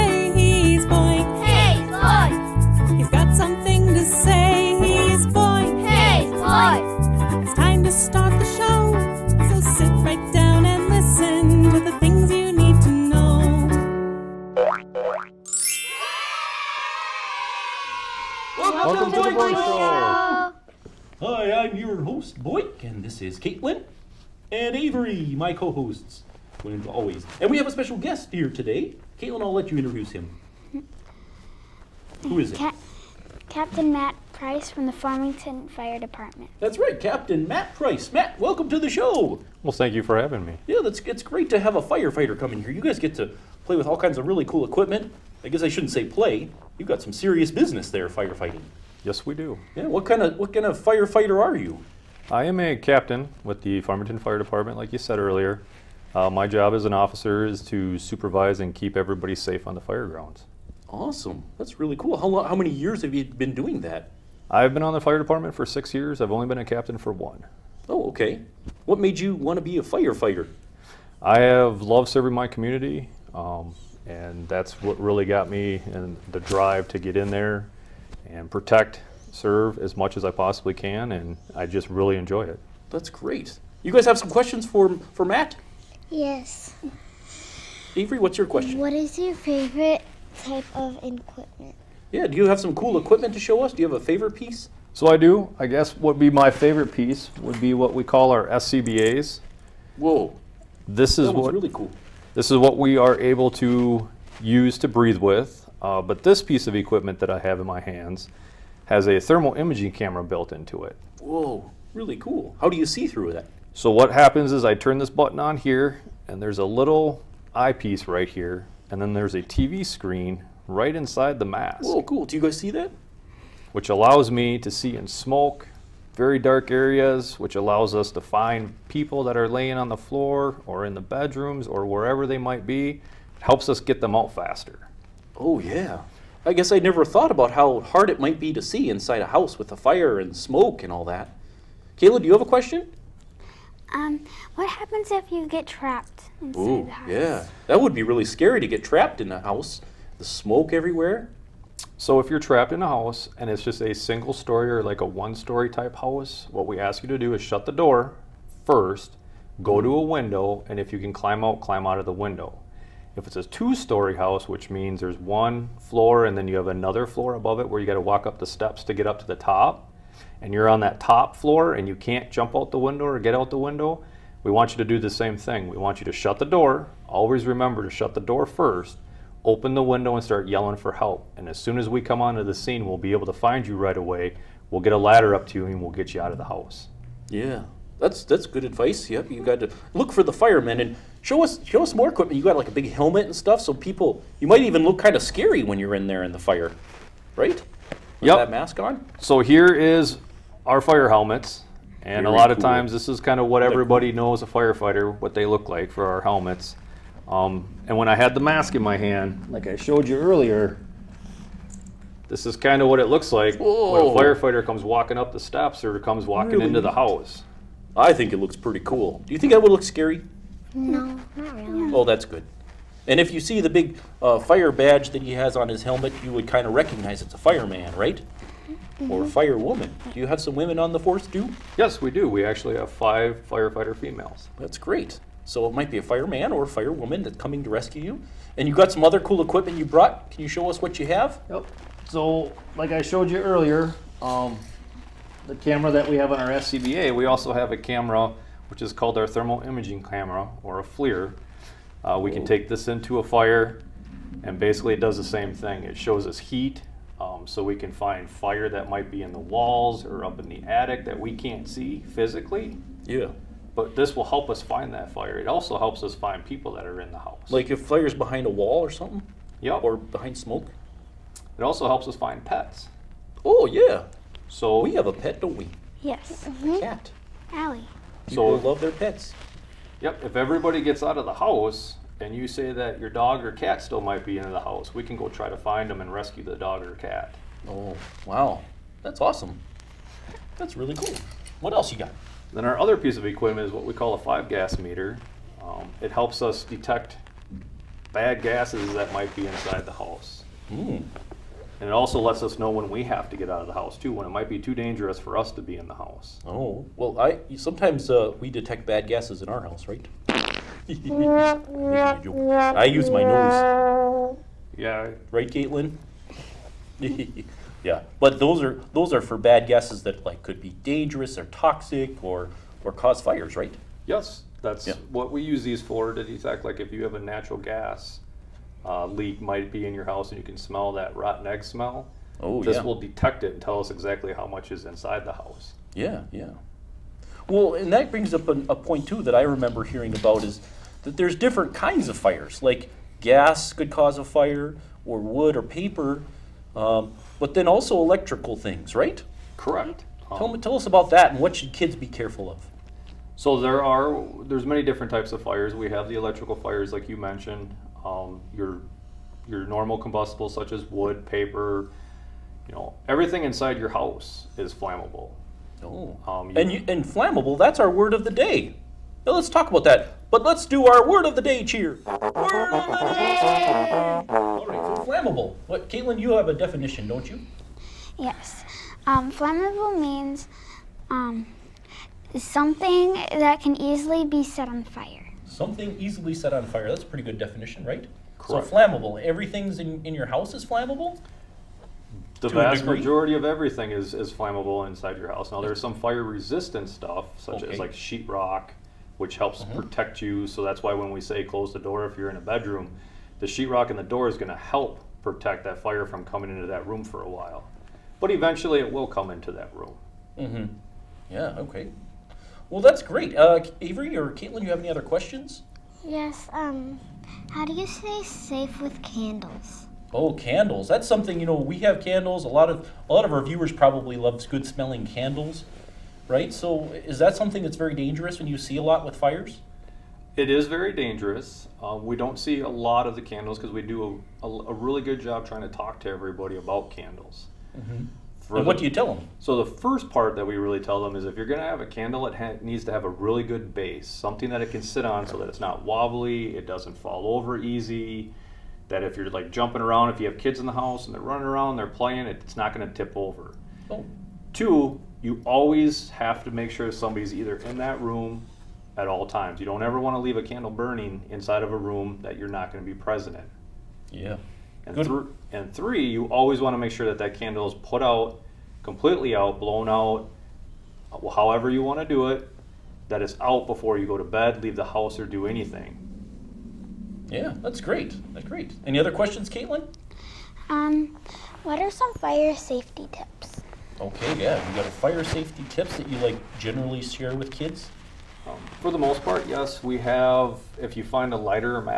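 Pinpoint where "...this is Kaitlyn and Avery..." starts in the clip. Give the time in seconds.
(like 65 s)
23 s.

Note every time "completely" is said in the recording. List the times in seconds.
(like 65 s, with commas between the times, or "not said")
468 s.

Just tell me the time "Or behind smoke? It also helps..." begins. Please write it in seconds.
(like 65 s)
269 s.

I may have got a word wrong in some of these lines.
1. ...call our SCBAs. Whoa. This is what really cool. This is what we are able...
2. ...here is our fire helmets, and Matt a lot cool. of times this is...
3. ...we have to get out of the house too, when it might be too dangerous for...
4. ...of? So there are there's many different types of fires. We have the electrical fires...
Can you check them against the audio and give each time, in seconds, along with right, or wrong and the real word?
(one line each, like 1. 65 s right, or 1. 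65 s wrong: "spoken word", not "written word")
1. 98 s right
2. 199 s wrong: "Very", not "Matt"
3. 302 s right
4. 352 s right.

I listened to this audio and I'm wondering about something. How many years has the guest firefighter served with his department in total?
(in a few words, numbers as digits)
6.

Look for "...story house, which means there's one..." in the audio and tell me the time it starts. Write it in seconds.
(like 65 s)
163 s.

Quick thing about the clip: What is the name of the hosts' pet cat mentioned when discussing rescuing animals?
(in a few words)
Allie.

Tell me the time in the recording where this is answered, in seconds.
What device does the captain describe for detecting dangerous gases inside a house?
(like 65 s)
294 s.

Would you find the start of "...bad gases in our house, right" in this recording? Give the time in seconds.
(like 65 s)
308 s.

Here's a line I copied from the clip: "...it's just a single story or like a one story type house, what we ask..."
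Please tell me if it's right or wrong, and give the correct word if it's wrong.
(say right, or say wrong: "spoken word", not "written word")
right.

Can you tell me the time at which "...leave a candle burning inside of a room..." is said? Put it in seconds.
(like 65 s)
460 s.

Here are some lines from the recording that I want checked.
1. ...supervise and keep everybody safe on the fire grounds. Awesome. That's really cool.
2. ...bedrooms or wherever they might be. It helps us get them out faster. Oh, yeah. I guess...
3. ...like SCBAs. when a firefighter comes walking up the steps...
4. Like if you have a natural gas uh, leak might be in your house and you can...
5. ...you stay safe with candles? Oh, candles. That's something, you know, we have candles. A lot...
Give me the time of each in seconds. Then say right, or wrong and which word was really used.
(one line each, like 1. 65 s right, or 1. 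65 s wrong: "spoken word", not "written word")
1. 57 s right
2. 131 s right
3. 213 s wrong: "Whoa", not "SCBAs"
4. 326 s right
5. 417 s right.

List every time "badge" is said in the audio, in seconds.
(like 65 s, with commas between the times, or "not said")
224 s.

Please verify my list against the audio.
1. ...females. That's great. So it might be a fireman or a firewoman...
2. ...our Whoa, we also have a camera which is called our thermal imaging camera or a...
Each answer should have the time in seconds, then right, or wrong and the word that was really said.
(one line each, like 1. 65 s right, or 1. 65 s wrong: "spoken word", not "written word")
1. 233 s right
2. 246 s wrong: "SCBA", not "Whoa".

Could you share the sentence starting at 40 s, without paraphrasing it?
Yeah, that's it's great to have a firefighter come in here.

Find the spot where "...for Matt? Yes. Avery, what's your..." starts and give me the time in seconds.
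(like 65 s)
85 s.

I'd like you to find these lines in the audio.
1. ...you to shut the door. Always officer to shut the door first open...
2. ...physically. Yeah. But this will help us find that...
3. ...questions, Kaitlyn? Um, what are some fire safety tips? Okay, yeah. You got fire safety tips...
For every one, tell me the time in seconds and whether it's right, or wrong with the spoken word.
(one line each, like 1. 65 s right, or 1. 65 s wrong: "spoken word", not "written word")
1. 175 s wrong: "remember", not "officer"
2. 262 s right
3. 479 s right.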